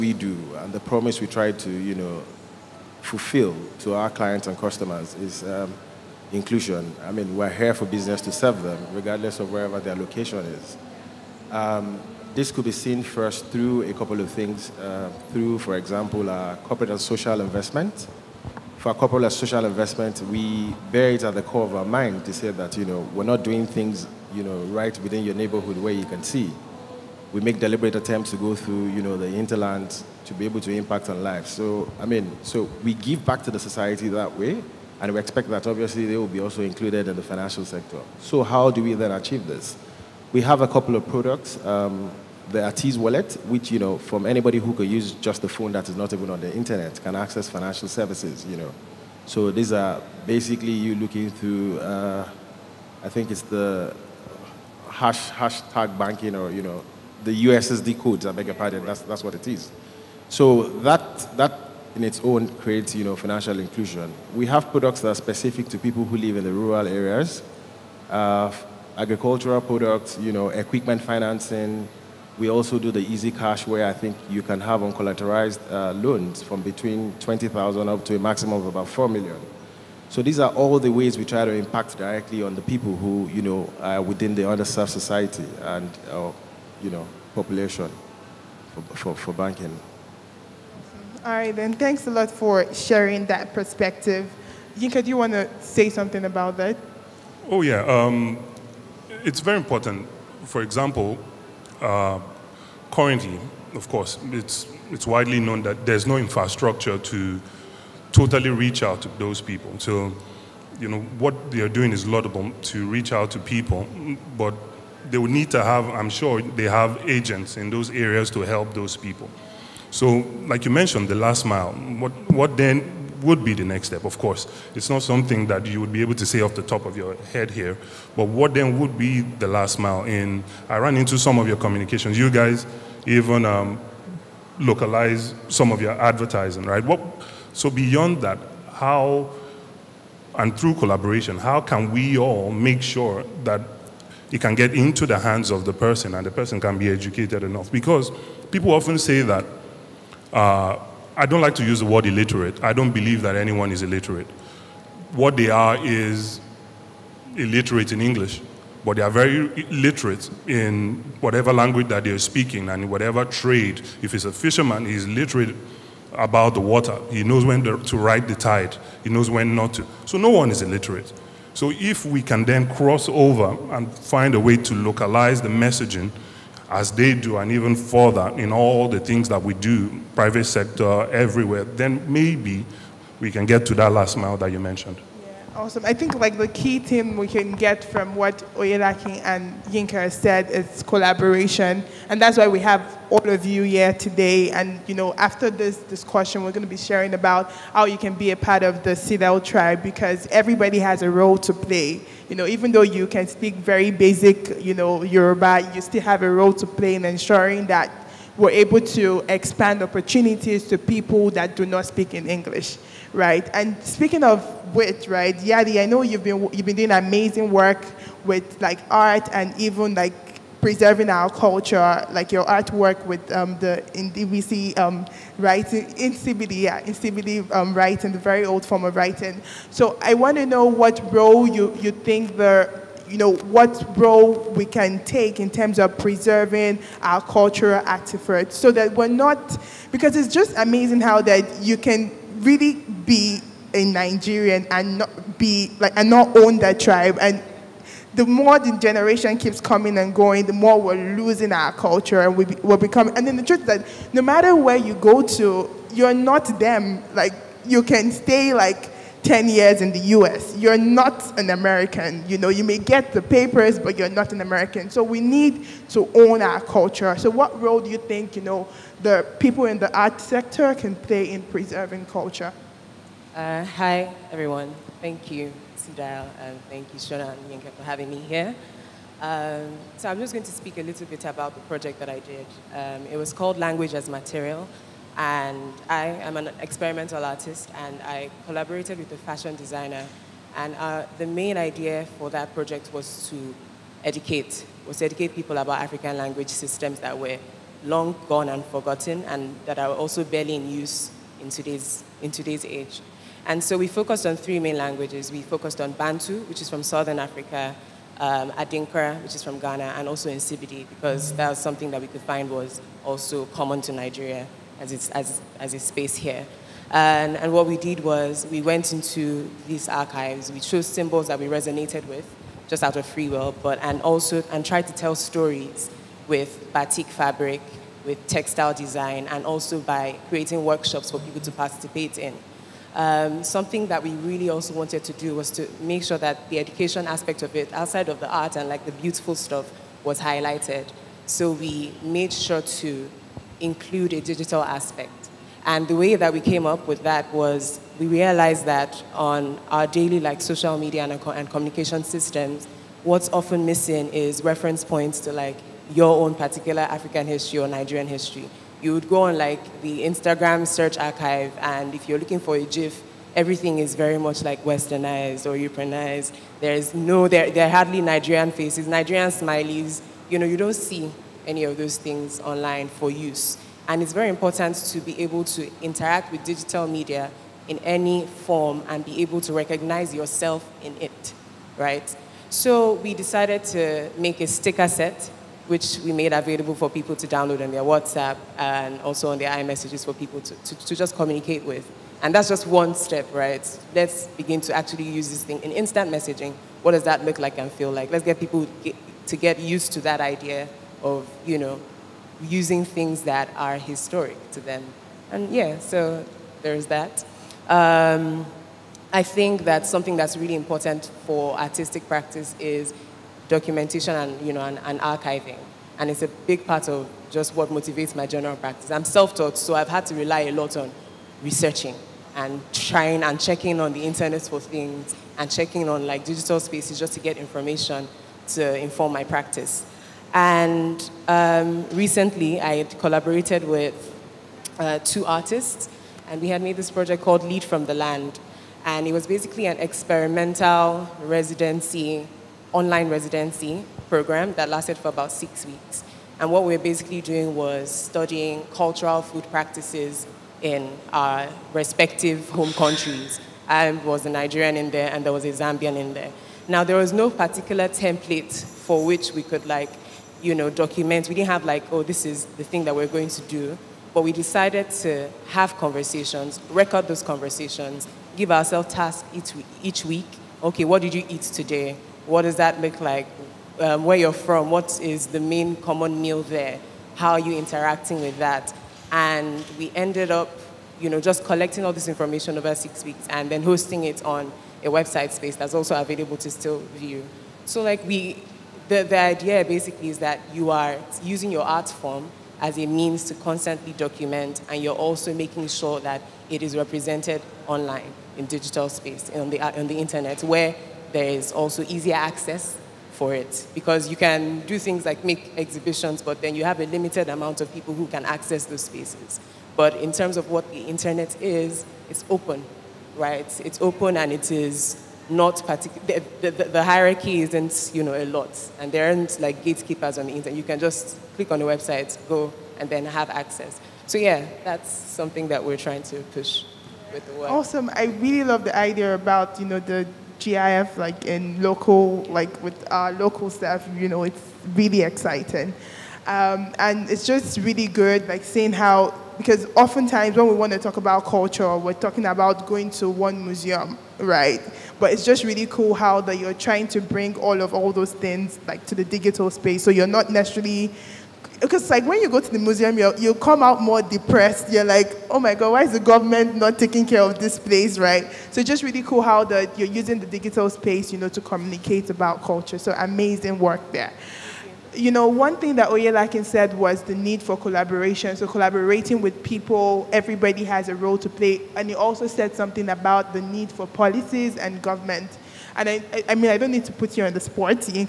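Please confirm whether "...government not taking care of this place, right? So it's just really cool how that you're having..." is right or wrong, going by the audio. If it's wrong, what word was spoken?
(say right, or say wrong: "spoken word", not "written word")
wrong: "using", not "having".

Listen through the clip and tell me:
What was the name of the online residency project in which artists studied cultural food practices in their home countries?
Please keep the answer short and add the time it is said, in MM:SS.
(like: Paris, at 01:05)
Lead from the Land, at 07:17.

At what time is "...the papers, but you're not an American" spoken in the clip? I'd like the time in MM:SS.
04:23.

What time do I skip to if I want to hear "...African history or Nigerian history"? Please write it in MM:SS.
05:56.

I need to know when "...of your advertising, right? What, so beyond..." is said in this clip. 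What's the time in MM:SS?
02:15.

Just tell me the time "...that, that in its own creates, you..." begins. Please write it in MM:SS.
01:00.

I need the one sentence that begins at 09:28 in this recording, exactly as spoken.
So collaborating with people, everybody has a role to play.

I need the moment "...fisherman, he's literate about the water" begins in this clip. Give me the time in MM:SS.
02:44.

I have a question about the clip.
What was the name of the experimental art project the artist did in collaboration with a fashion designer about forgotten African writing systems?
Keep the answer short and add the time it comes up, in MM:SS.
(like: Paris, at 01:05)
Language as Material, at 04:43.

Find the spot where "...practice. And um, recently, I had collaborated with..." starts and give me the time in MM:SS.
07:09.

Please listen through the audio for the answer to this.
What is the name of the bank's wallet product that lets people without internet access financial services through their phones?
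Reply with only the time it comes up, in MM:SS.
00:42.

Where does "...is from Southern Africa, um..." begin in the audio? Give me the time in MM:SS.
05:06.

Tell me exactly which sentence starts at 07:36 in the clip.
Now, there was no particular template for which we could like you know, document.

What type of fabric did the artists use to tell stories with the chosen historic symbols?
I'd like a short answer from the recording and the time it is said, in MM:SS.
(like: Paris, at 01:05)
Batik, at 05:26.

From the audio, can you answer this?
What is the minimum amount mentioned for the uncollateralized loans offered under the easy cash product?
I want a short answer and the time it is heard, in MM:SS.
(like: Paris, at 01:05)
20,000, at 01:17.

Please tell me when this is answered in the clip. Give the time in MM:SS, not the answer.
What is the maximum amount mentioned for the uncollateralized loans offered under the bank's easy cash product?
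01:18.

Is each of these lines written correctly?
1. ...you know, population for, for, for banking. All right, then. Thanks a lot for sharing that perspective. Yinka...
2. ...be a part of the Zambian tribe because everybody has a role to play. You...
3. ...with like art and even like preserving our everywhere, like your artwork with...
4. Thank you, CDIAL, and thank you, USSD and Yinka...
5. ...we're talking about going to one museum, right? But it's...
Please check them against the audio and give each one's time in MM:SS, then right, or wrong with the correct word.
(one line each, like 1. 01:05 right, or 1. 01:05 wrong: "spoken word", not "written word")
1. 01:26 right
2. 03:18 wrong: "CDIAL", not "Zambian"
3. 03:38 wrong: "culture", not "everywhere"
4. 04:35 wrong: "Shona", not "USSD"
5. 09:01 right.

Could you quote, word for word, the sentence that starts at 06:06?
There's no, there, there are hardly Nigerian faces, Nigerian smileys.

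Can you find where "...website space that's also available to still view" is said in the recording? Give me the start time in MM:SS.
08:04.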